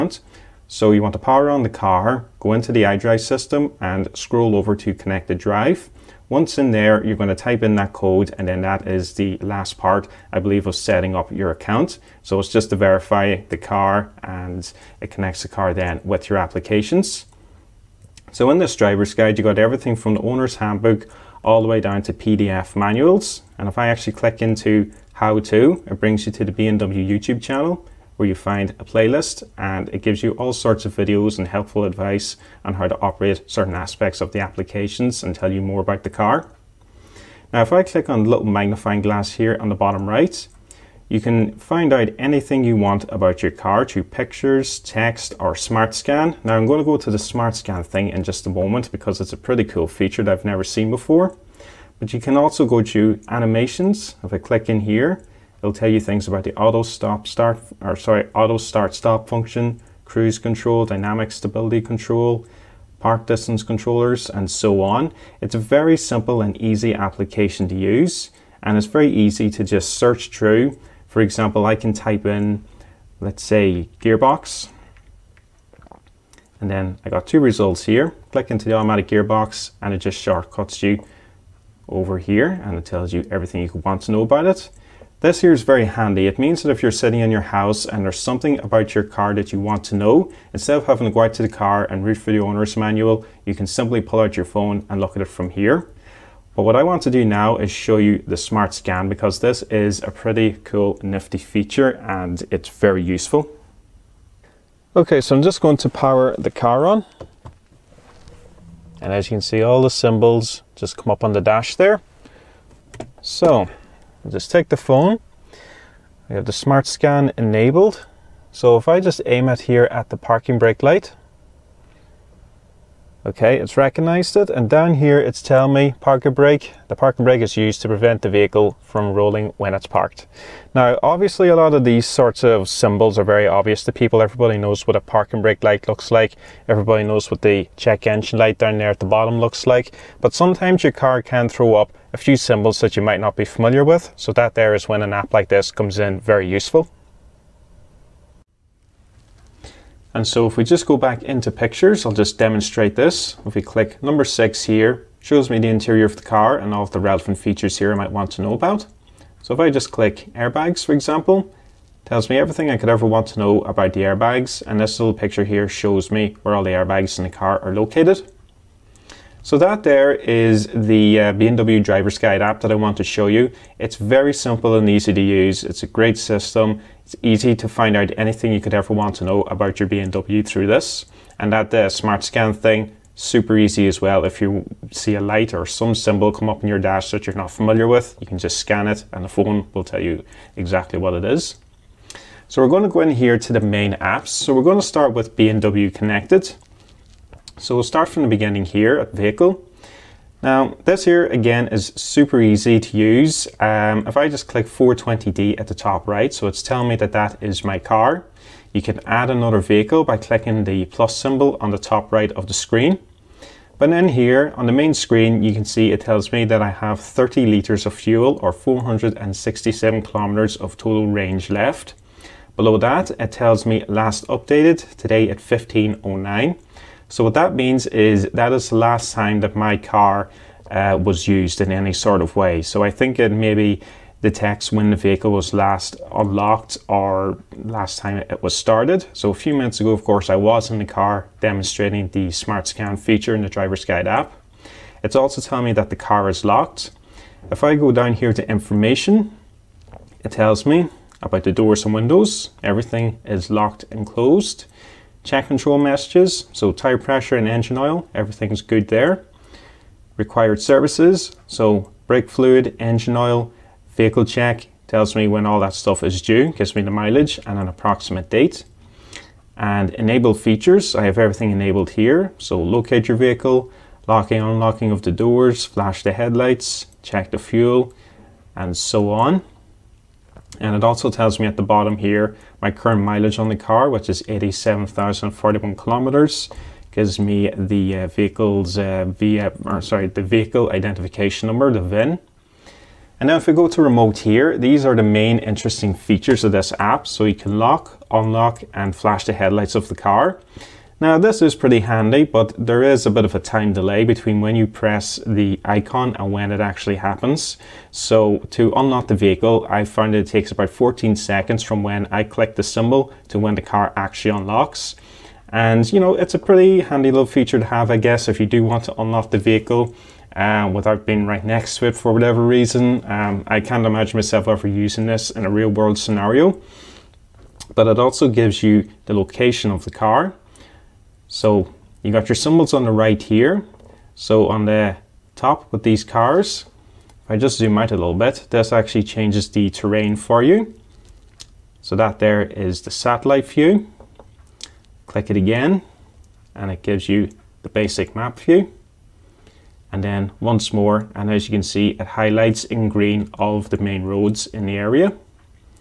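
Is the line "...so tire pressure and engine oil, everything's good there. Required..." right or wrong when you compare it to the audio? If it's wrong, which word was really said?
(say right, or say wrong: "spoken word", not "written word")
right.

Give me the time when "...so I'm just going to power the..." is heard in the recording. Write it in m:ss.
1:45.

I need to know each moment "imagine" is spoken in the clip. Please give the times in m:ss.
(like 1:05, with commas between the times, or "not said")
5:23.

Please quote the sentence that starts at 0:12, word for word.
So it's just to verify the car and it connects the car then with your applications.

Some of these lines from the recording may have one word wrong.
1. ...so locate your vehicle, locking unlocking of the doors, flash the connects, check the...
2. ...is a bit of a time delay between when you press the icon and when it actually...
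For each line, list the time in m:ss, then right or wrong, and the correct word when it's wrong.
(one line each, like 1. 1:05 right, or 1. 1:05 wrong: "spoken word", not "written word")
1. 4:32 wrong: "headlights", not "connects"
2. 5:02 right.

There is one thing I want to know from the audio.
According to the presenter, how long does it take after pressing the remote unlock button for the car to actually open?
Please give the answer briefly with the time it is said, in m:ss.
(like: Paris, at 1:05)
14 seconds, at 5:10.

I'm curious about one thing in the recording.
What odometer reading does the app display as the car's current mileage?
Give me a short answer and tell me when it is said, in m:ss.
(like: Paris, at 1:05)
87,041 kilometers, at 4:44.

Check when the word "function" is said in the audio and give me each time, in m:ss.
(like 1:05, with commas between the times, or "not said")
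0:59.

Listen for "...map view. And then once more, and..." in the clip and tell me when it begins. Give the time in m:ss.
5:48.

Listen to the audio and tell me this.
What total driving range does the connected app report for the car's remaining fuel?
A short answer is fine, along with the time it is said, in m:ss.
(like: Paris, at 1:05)
467 kilometres, at 3:38.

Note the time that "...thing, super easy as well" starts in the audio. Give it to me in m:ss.
3:02.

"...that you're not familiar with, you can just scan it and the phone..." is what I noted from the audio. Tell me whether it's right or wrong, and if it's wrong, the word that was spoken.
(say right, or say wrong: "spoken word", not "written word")
right.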